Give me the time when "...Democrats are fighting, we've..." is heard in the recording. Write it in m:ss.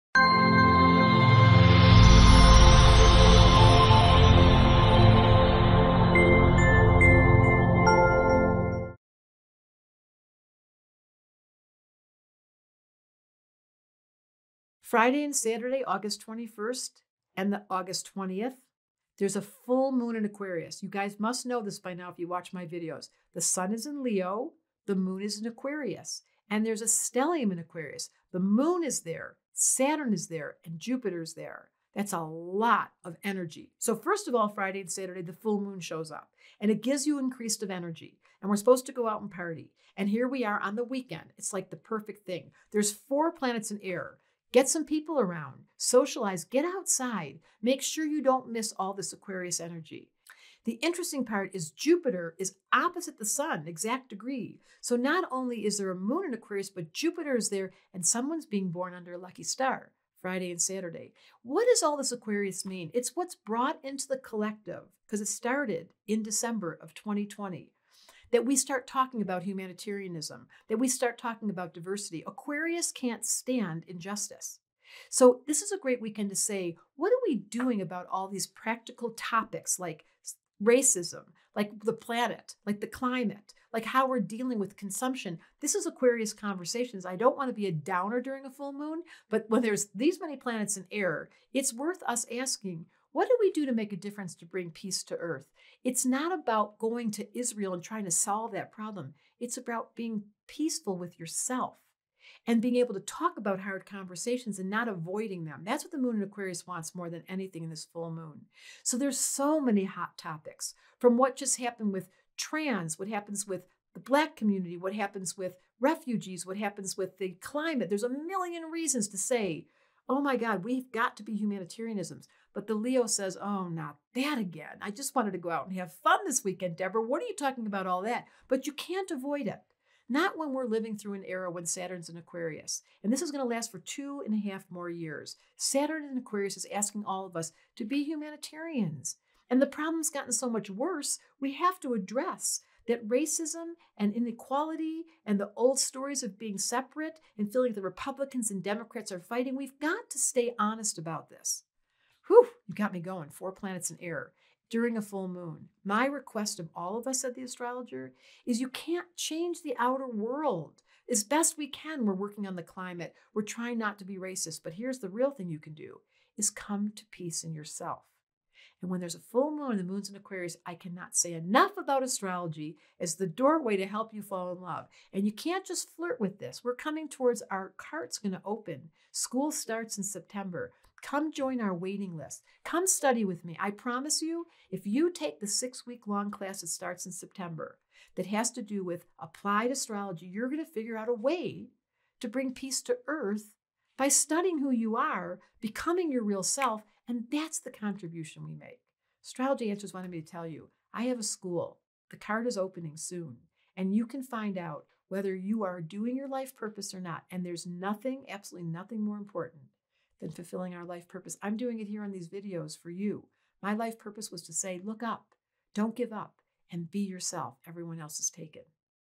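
2:28.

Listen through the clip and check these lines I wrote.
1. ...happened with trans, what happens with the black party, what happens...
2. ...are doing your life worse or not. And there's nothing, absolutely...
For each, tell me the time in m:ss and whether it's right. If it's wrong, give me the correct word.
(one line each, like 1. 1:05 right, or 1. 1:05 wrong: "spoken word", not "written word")
1. 1:51 wrong: "community", not "party"
2. 3:25 wrong: "purpose", not "worse".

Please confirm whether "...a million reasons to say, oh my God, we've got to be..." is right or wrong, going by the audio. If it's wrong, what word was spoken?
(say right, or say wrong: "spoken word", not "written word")
right.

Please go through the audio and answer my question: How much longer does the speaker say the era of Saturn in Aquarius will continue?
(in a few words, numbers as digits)
2.5 years.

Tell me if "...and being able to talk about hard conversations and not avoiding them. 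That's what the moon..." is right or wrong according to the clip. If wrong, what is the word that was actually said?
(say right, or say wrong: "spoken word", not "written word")
right.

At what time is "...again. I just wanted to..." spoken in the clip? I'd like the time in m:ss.
2:04.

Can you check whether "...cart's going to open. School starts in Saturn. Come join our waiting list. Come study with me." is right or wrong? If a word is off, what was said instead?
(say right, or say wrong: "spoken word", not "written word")
wrong: "September", not "Saturn".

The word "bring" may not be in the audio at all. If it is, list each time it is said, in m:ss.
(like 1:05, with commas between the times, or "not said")
1:34, 3:12.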